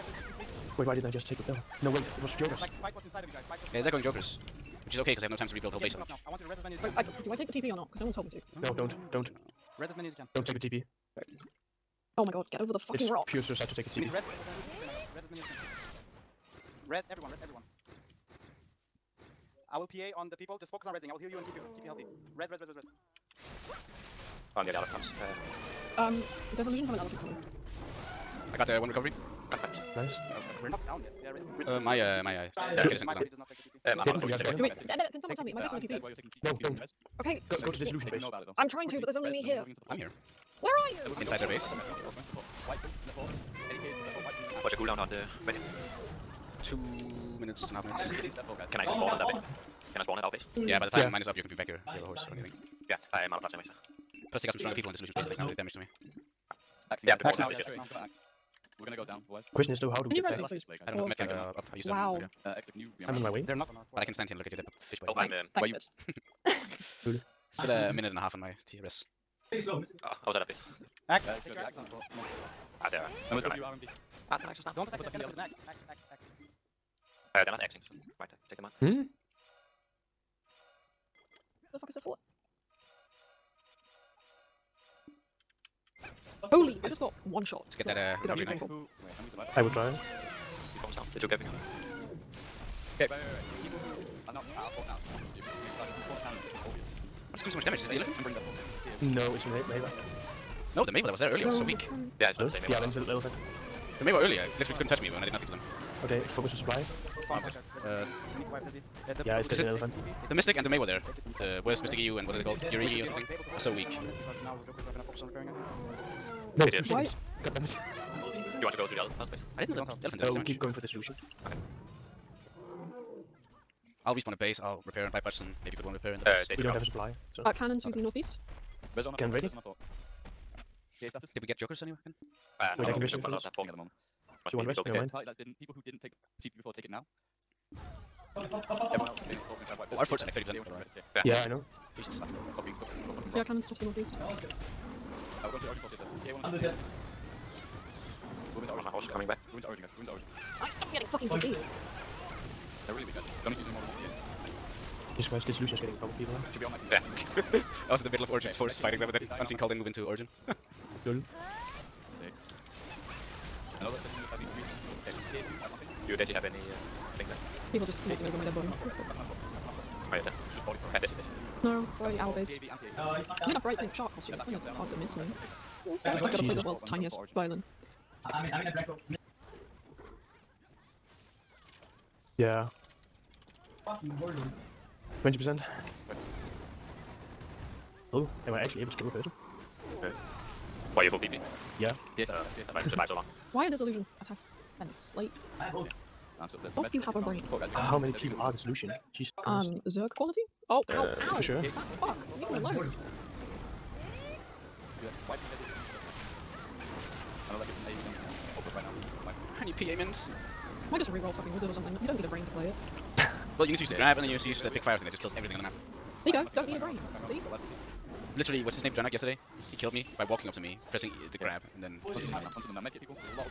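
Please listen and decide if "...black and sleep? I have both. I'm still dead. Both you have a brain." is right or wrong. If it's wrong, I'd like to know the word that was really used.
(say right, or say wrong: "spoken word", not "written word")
wrong: "attack", not "black".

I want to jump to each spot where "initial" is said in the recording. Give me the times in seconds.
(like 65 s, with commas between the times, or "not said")
not said.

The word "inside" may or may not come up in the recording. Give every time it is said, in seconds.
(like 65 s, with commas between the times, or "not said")
3 s, 41 s.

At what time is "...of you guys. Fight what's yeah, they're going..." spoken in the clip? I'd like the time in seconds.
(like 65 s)
3 s.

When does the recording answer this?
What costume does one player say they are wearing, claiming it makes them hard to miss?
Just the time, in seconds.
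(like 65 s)
173 s.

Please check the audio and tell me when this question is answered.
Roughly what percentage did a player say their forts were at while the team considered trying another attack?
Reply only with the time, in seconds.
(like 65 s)
140 s.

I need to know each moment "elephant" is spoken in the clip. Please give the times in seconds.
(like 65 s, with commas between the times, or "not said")
26 s, 75 s, 97 s, 109 s, 120 s.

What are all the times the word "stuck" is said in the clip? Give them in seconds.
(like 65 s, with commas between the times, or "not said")
142 s.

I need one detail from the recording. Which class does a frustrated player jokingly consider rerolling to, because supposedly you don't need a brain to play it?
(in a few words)
Wizard.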